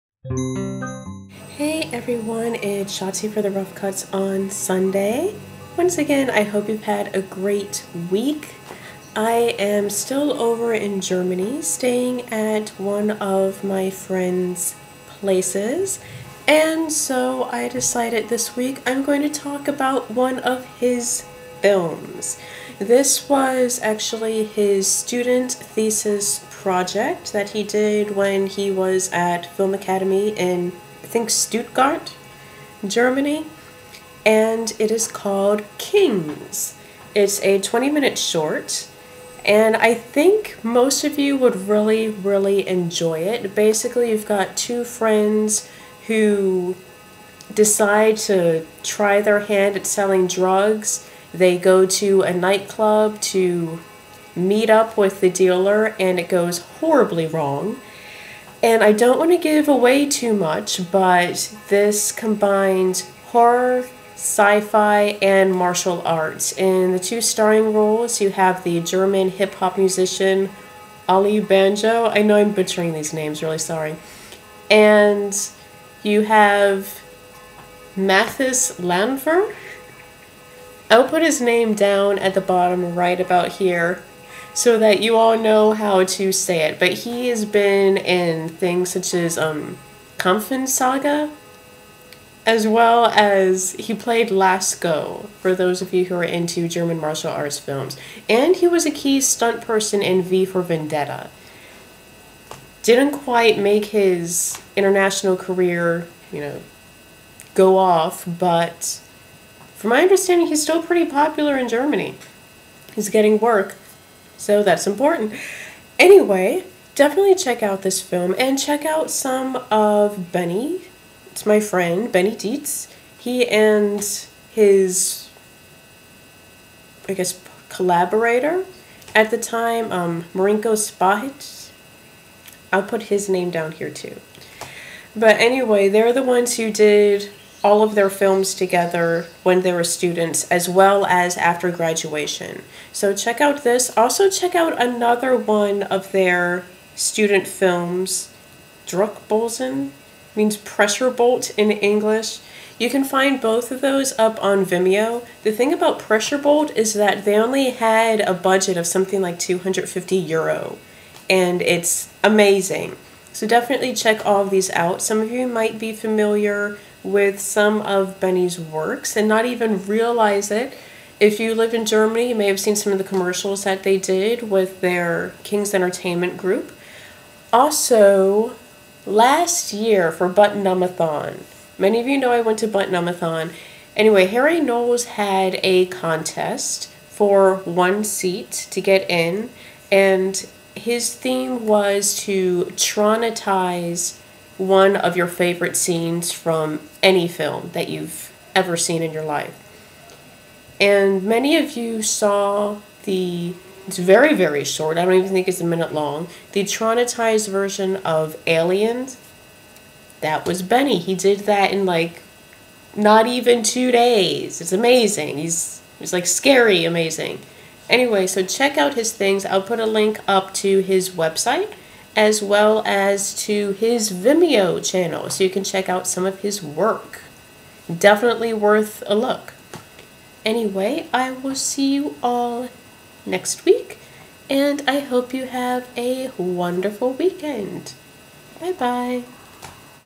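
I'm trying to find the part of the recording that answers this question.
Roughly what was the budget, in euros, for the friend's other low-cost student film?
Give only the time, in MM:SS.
02:39.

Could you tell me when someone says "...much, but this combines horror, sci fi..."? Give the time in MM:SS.
01:00.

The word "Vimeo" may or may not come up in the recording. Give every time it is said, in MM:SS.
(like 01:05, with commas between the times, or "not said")
02:34, 03:44.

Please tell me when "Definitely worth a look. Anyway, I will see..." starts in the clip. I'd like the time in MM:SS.
03:47.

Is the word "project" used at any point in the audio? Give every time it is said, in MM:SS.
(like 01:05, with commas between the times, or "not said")
00:26.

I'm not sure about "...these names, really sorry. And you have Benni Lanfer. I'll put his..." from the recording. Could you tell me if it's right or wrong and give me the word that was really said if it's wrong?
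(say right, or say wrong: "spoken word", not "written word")
wrong: "Mathis", not "Benni".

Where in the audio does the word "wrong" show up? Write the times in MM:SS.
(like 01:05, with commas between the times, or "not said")
00:57.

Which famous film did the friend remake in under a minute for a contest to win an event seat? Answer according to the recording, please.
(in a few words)
Aliens.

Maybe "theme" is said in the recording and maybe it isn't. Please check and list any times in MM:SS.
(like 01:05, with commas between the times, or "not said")
03:11.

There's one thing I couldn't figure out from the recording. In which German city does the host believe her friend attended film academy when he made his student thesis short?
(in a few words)
Stuttgart.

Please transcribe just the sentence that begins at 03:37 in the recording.
Anyway, so check out his things.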